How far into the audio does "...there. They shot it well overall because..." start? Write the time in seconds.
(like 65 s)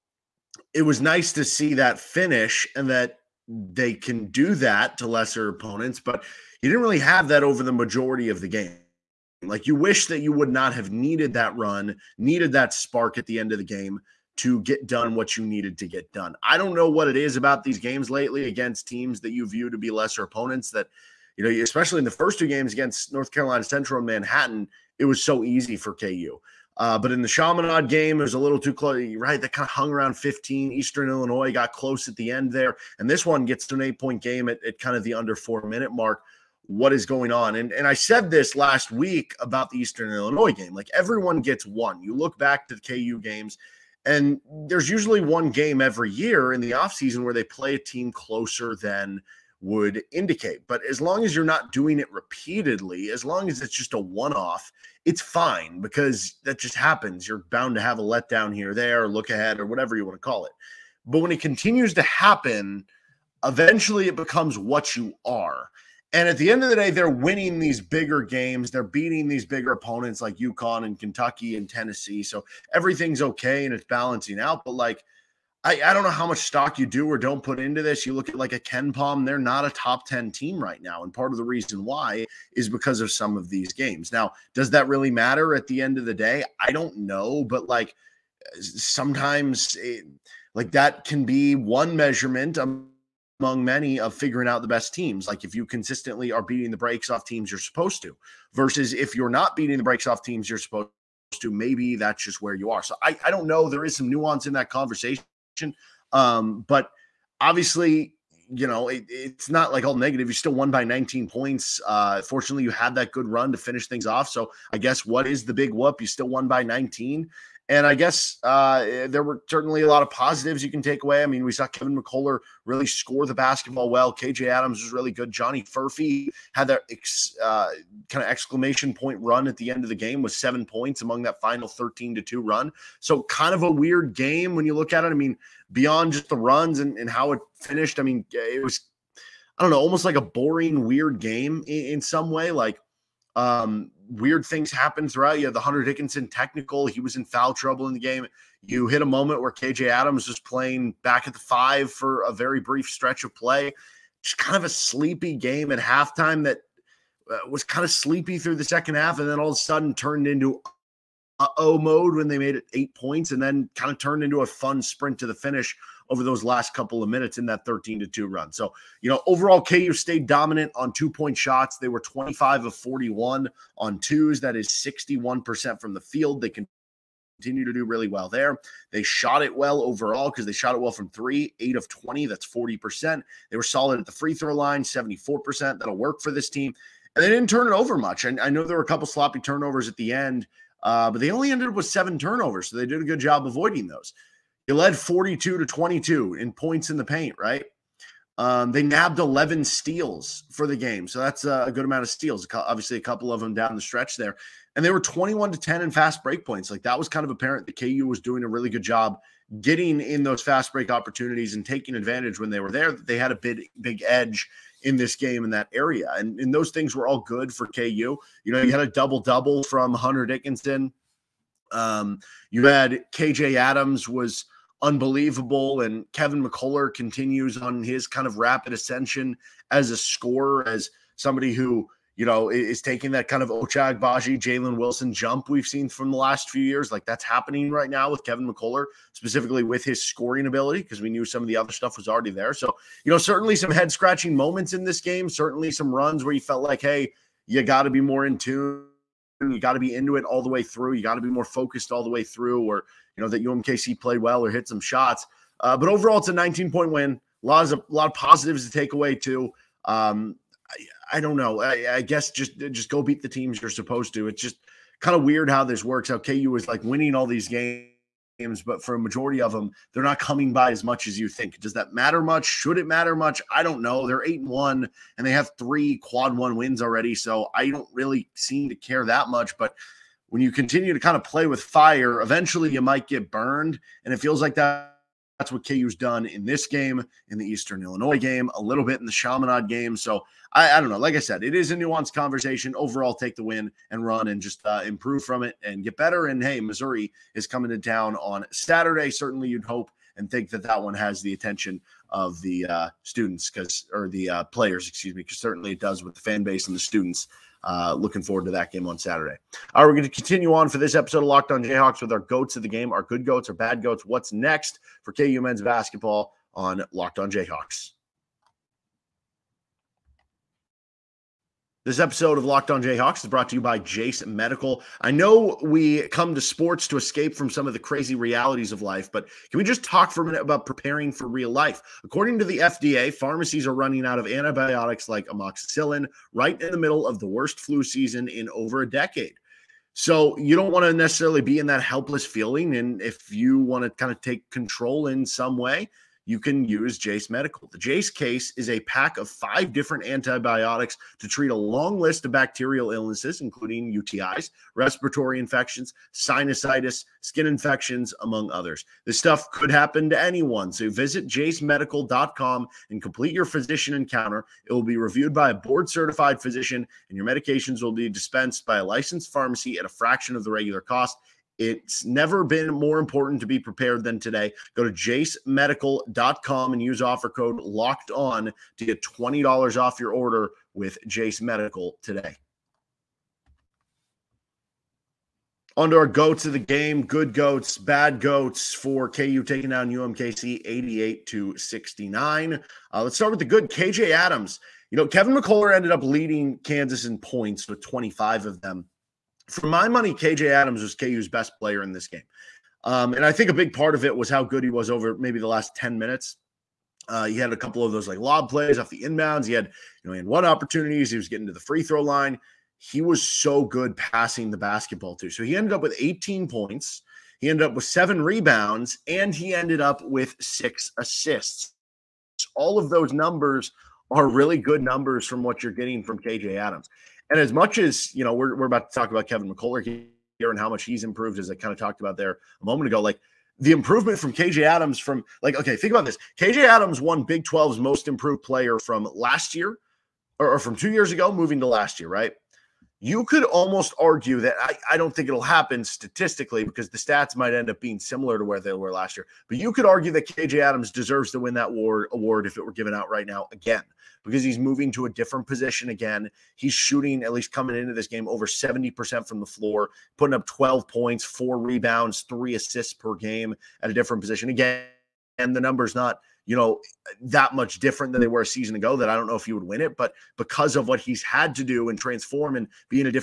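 178 s.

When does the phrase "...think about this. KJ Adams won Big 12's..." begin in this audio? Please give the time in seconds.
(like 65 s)
435 s.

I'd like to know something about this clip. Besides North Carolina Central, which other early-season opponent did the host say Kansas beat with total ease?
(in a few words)
Manhattan.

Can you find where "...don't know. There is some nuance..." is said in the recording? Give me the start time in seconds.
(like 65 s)
103 s.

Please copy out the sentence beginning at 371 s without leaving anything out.
It's never been more important to be prepared than today.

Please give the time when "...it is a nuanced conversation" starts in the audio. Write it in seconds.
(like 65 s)
291 s.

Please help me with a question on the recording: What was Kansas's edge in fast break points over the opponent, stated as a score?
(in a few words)
21 to 10.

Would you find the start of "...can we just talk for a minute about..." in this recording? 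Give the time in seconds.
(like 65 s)
329 s.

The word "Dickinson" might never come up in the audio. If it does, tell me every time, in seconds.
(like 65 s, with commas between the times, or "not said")
145 s, 220 s.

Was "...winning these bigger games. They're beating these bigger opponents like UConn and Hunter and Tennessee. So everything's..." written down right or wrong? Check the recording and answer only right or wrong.
wrong.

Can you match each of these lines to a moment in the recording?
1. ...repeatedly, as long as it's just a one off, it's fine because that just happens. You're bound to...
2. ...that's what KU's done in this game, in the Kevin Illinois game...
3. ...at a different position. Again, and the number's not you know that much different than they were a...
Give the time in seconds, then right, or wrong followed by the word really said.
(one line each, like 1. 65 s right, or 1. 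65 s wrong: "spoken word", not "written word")
1. 52 s right
2. 285 s wrong: "Eastern", not "Kevin"
3. 463 s right.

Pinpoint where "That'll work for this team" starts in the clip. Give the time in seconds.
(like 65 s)
185 s.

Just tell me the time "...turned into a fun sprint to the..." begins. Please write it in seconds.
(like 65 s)
163 s.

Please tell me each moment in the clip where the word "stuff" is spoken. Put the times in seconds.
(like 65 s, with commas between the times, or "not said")
241 s, 359 s.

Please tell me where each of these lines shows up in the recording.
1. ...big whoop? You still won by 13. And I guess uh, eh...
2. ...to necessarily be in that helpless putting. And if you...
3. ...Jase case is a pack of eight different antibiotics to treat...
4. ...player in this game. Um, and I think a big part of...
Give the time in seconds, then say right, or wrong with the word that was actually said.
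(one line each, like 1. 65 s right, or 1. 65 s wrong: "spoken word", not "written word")
1. 115 s wrong: "19", not "13"
2. 340 s wrong: "feeling", not "putting"
3. 347 s wrong: "five", not "eight"
4. 401 s right.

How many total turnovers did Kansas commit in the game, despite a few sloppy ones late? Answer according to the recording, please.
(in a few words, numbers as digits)
7.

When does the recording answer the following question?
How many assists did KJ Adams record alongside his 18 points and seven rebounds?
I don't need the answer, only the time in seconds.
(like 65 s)
420 s.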